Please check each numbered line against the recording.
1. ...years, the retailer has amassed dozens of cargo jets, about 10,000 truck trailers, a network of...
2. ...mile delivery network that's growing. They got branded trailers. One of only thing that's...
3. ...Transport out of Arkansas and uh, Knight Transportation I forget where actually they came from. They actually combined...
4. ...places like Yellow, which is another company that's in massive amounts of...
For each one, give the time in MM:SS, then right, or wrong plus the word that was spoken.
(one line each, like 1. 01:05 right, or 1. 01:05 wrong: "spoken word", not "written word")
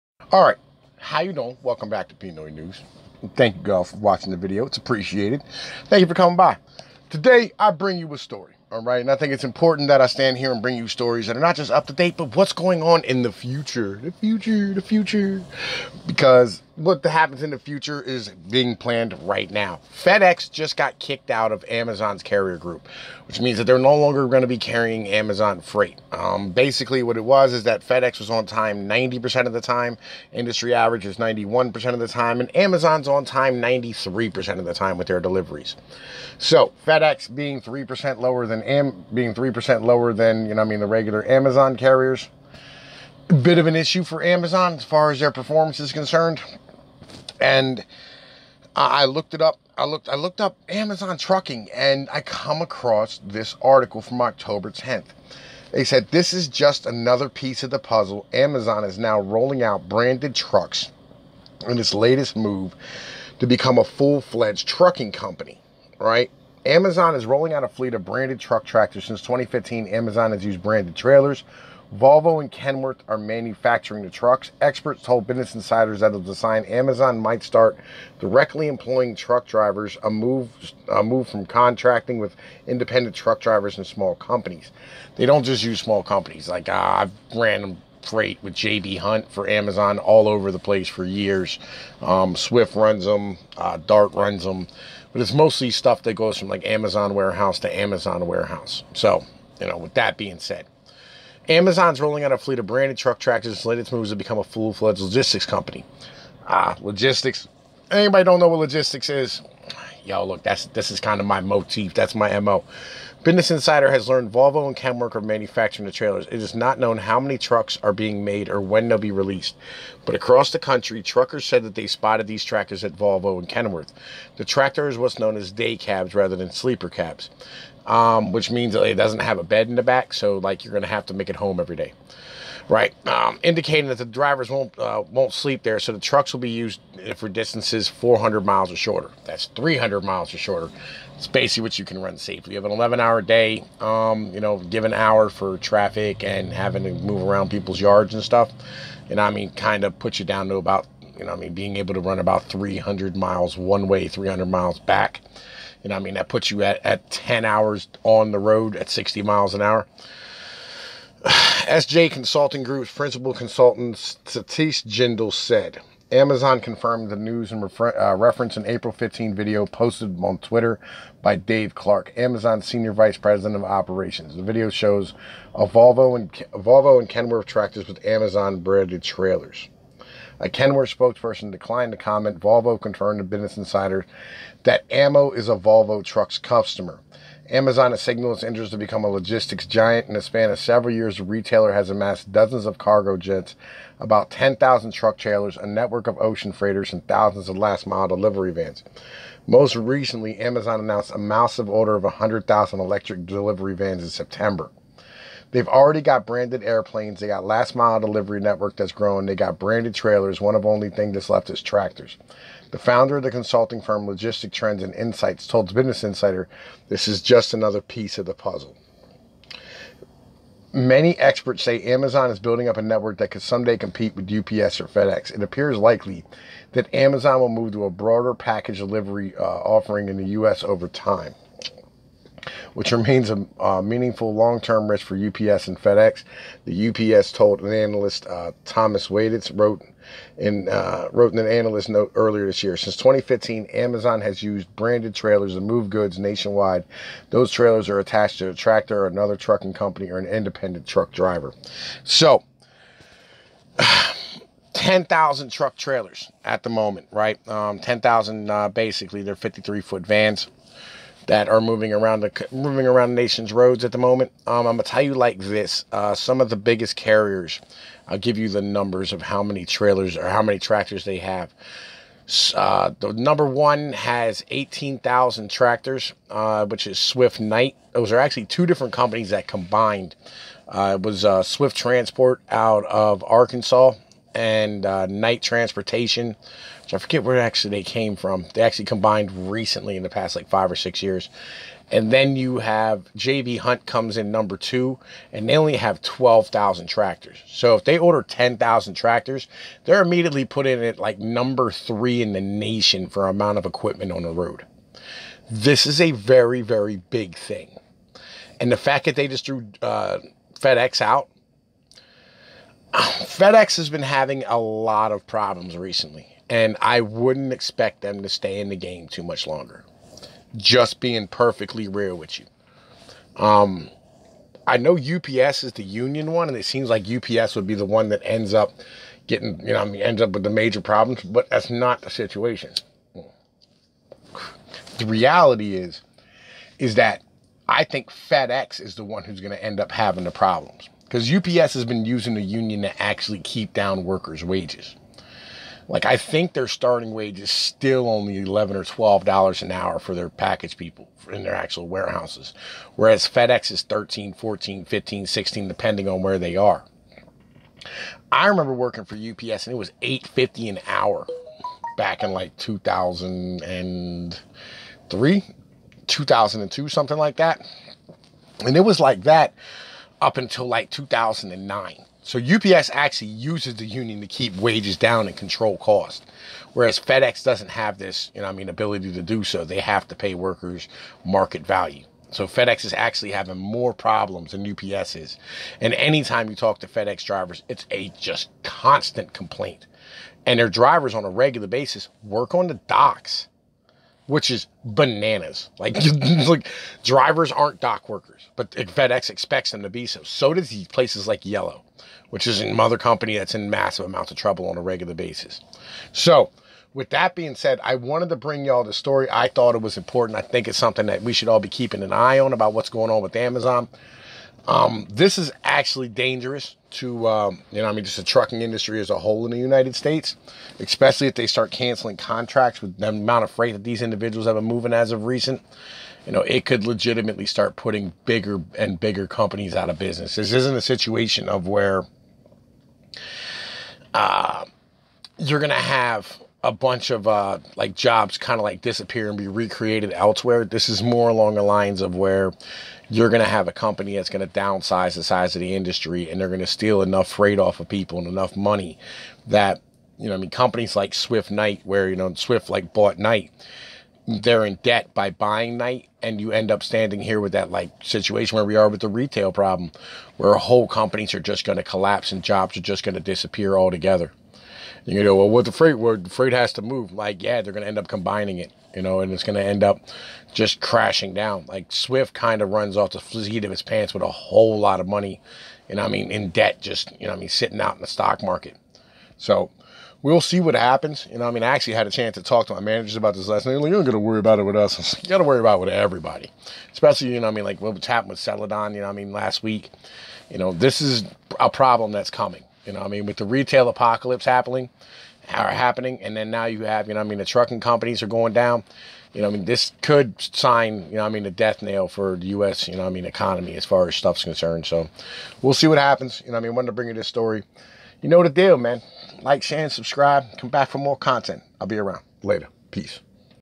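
1. 03:10 right
2. 03:27 right
3. 04:41 right
4. 06:40 right.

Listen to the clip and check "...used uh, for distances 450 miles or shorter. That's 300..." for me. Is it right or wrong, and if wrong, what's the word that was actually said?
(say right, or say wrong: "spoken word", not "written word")
wrong: "400", not "450".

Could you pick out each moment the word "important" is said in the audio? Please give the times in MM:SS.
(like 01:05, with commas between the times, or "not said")
00:09, 06:49.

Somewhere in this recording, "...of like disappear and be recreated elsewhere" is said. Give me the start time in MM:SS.
07:18.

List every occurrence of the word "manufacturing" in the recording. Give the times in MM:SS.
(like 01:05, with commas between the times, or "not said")
01:13, 01:55.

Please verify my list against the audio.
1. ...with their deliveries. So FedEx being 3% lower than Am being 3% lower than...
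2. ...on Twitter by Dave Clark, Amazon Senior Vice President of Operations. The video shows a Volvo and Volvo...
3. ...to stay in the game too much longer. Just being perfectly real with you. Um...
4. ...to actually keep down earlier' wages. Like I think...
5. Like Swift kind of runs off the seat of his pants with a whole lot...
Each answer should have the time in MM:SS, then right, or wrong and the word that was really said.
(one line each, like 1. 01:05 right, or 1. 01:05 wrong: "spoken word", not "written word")
1. 00:34 right
2. 02:50 right
3. 05:18 right
4. 05:42 wrong: "workers", not "earlier"
5. 07:51 right.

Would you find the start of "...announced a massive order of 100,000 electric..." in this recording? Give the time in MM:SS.
03:20.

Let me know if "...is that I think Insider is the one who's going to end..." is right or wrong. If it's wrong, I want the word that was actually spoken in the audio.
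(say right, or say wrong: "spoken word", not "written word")
wrong: "FedEx", not "Insider".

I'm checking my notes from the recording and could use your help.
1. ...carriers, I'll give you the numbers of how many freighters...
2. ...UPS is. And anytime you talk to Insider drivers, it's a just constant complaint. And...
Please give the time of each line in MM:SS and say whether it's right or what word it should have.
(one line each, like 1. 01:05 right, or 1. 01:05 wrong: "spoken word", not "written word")
1. 04:26 wrong: "trailers", not "freighters"
2. 06:24 wrong: "FedEx", not "Insider".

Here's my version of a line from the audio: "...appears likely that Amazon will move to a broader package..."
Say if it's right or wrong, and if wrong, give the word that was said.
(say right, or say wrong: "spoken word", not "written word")
right.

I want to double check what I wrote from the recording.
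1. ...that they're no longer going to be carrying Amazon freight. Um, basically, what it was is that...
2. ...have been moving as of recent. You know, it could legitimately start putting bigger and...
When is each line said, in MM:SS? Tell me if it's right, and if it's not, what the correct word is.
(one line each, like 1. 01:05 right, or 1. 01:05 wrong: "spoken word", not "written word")
1. 00:23 right
2. 07:04 right.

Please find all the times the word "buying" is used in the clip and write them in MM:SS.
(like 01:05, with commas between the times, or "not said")
07:35.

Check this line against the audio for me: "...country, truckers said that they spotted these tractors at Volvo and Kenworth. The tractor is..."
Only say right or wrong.
right.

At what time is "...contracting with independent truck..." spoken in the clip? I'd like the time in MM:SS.
01:21.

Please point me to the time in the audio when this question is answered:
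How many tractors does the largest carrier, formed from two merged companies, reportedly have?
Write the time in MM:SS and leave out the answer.
04:34.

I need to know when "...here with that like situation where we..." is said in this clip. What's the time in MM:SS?
07:37.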